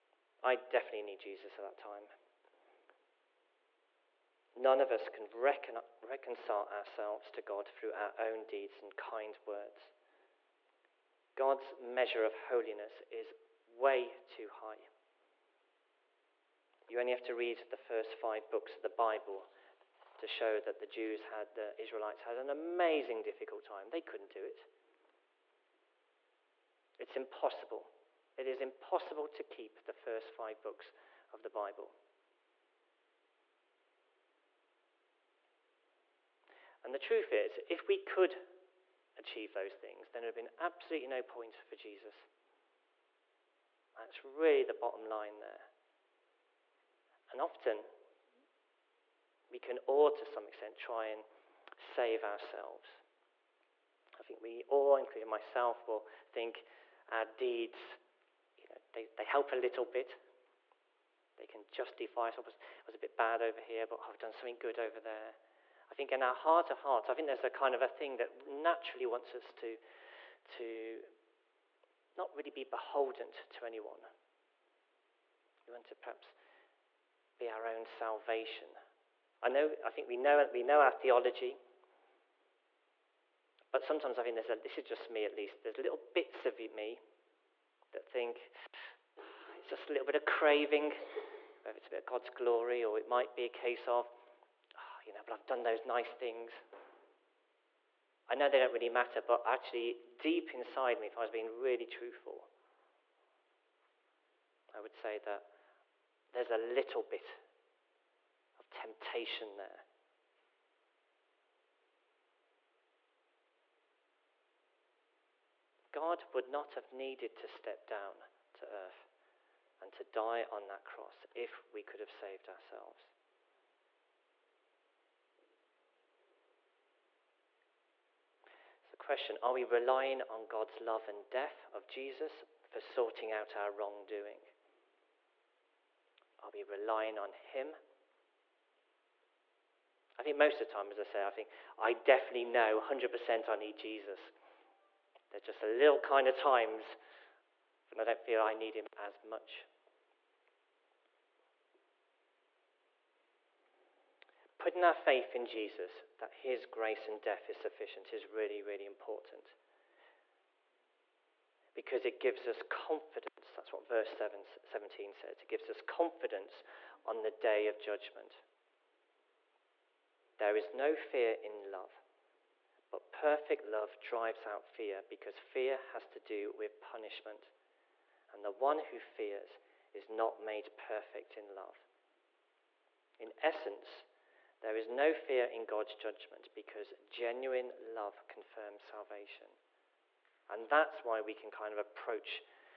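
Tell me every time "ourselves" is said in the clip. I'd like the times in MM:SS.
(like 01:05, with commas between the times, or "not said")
00:06, 00:52, 02:02.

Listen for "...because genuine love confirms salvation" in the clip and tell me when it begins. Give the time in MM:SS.
03:06.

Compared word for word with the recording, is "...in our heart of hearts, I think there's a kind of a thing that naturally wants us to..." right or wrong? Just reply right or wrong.
right.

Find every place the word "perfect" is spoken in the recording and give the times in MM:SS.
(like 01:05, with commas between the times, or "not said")
02:53, 03:00.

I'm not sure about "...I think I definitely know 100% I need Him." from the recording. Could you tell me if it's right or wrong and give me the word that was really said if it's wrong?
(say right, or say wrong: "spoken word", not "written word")
wrong: "Jesus", not "Him".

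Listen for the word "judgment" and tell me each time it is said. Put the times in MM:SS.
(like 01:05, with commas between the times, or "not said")
02:47, 03:05.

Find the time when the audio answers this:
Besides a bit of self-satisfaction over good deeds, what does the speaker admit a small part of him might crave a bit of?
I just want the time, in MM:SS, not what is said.
01:32.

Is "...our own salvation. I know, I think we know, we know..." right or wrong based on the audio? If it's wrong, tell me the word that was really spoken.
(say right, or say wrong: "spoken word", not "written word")
right.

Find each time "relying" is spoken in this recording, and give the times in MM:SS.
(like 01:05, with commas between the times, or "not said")
02:09, 02:16.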